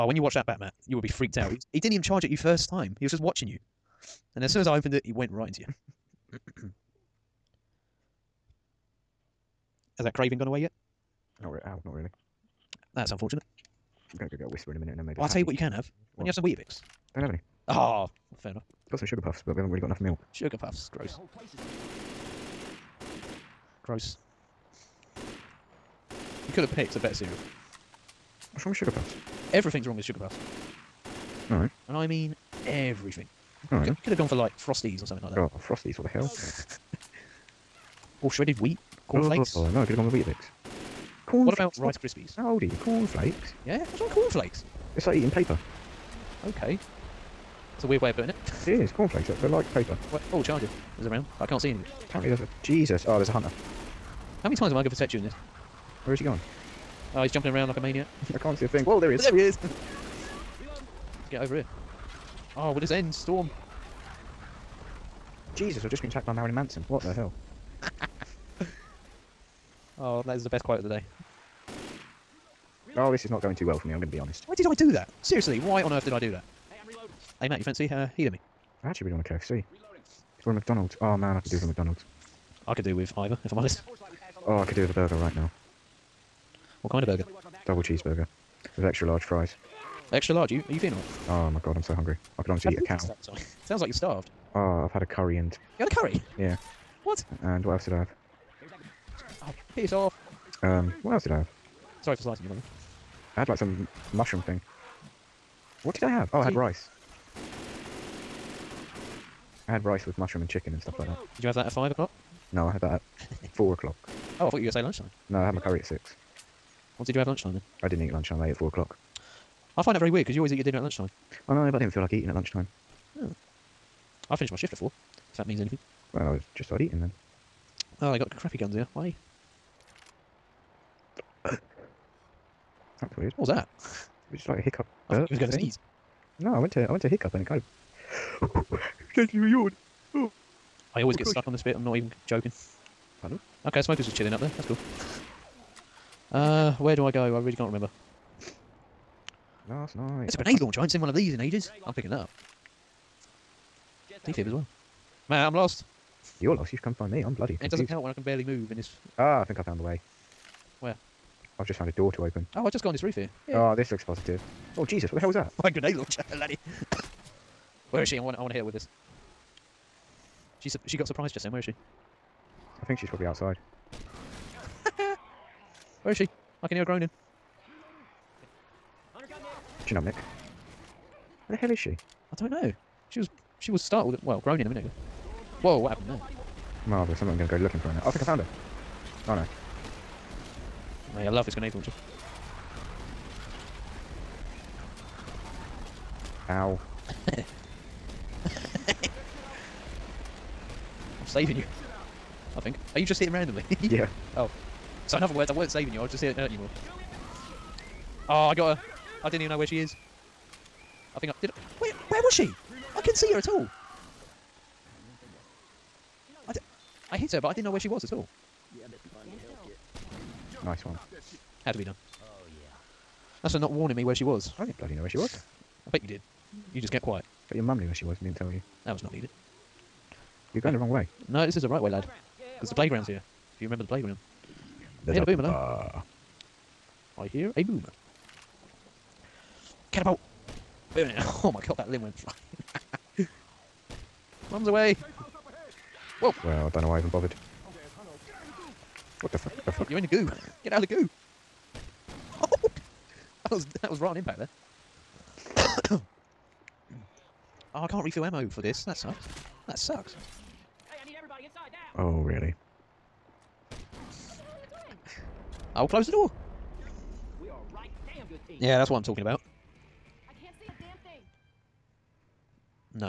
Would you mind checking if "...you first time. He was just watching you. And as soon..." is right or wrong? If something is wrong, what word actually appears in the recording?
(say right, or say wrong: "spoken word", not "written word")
right.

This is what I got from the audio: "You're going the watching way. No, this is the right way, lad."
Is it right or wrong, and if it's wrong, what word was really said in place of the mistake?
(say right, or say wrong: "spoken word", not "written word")
wrong: "wrong", not "watching".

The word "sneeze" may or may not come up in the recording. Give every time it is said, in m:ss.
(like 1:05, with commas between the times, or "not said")
2:15.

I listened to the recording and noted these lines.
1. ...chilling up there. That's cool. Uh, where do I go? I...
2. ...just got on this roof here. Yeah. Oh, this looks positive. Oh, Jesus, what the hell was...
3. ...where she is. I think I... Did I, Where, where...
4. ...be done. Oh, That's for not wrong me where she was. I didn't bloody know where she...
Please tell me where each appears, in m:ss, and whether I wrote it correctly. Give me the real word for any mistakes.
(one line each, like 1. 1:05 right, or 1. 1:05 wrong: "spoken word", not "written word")
1. 2:24 right
2. 2:42 right
3. 3:29 right
4. 3:41 wrong: "warning", not "wrong".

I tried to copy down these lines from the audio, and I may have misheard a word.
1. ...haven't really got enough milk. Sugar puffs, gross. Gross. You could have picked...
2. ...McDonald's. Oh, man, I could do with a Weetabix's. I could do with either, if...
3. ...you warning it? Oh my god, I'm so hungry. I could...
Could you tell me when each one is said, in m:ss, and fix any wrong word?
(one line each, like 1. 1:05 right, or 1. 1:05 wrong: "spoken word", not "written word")
1. 0:19 right
2. 1:20 wrong: "McDonald", not "Weetabix"
3. 1:30 wrong: "feeling", not "warning".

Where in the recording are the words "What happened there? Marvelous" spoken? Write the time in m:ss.
3:05.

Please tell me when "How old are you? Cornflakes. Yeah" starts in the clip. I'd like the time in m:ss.
0:42.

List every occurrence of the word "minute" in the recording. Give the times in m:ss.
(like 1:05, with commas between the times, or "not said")
0:14, 3:04.